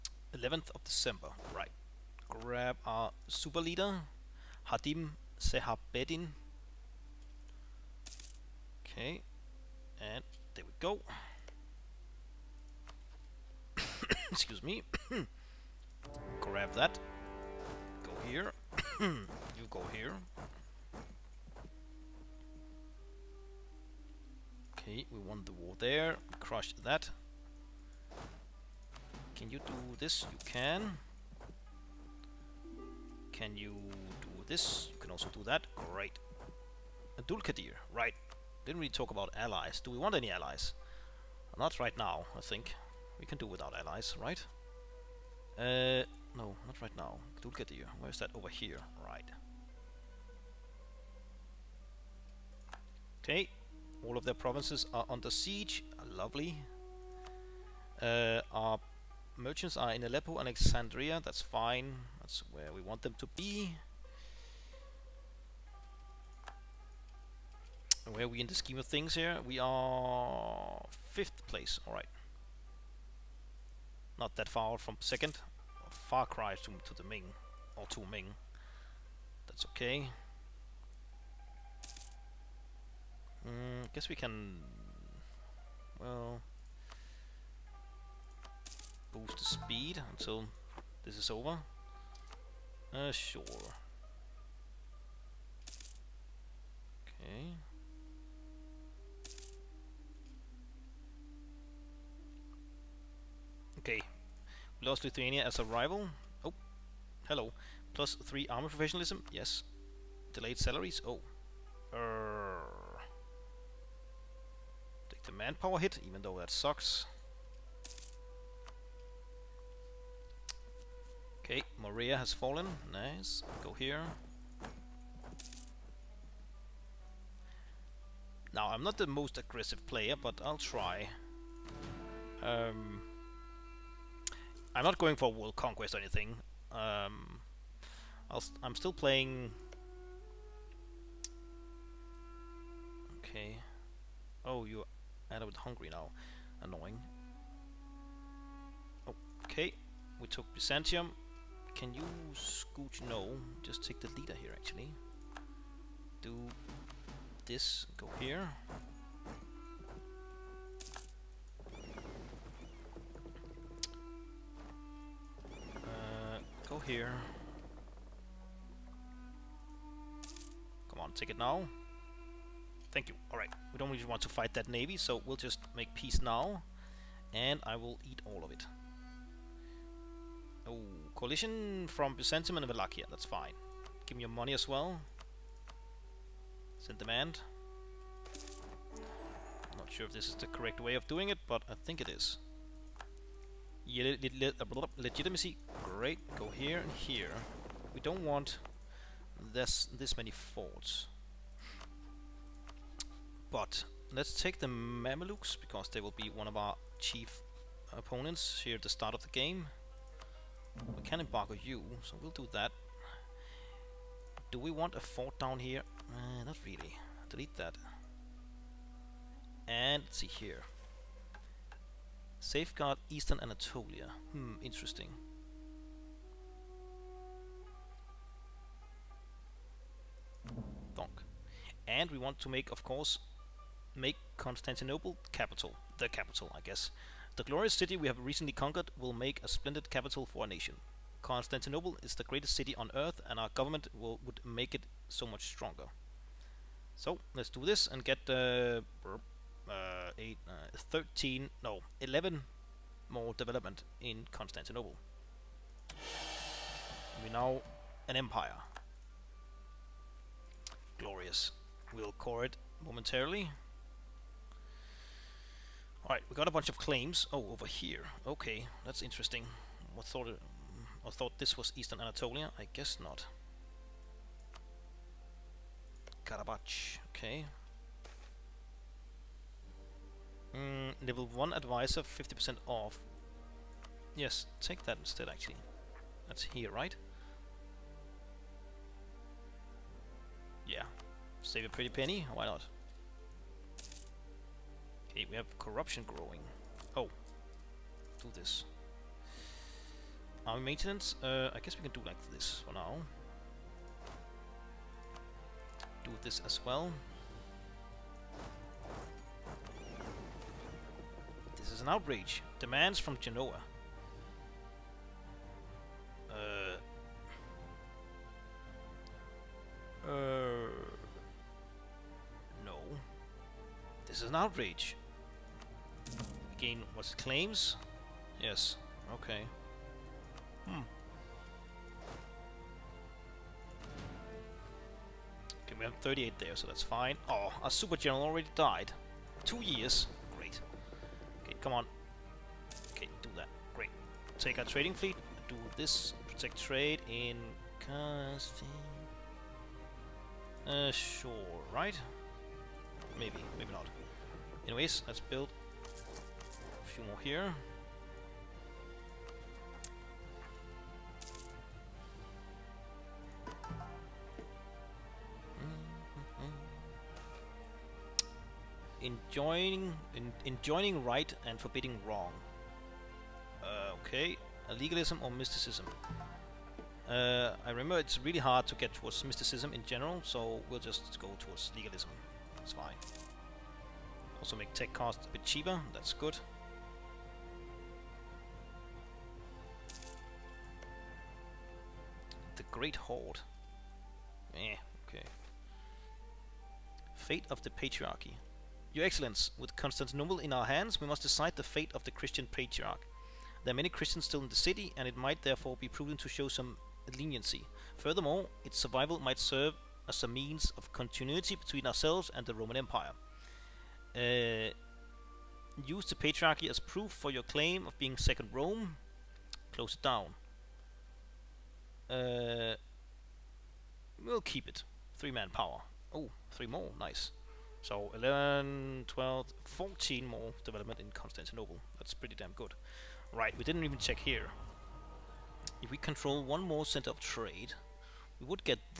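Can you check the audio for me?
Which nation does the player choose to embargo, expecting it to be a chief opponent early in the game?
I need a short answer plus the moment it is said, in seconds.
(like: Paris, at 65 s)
Mamelukes, at 204 s.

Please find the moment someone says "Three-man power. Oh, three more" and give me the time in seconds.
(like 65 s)
425 s.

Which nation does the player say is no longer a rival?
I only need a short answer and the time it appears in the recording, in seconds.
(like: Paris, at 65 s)
Lithuania, at 105 s.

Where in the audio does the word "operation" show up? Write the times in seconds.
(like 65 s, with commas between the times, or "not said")
not said.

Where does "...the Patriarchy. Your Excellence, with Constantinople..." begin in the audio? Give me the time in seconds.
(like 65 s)
397 s.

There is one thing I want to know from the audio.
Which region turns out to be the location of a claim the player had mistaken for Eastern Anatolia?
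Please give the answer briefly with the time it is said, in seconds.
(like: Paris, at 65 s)
Karabakh, at 276 s.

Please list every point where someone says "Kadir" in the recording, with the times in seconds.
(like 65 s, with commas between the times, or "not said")
37 s, 47 s.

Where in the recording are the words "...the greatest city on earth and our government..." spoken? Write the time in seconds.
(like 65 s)
242 s.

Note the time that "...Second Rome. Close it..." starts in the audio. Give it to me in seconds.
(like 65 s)
418 s.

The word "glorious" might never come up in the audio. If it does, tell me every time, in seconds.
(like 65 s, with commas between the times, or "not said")
237 s, 260 s.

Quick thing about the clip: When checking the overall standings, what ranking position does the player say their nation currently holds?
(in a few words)
Fifth place.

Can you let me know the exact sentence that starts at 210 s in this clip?
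We can embargo you, so we'll do that.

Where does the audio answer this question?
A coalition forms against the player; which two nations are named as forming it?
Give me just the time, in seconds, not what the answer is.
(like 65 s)
182 s.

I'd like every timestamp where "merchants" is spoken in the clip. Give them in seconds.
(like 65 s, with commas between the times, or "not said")
59 s.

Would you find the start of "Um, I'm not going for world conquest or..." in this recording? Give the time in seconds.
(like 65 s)
132 s.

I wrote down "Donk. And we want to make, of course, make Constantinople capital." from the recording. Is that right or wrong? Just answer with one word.
right.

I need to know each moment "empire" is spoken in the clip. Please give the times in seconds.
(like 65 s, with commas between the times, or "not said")
258 s, 412 s.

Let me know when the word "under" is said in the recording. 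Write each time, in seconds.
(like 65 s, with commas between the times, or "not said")
55 s.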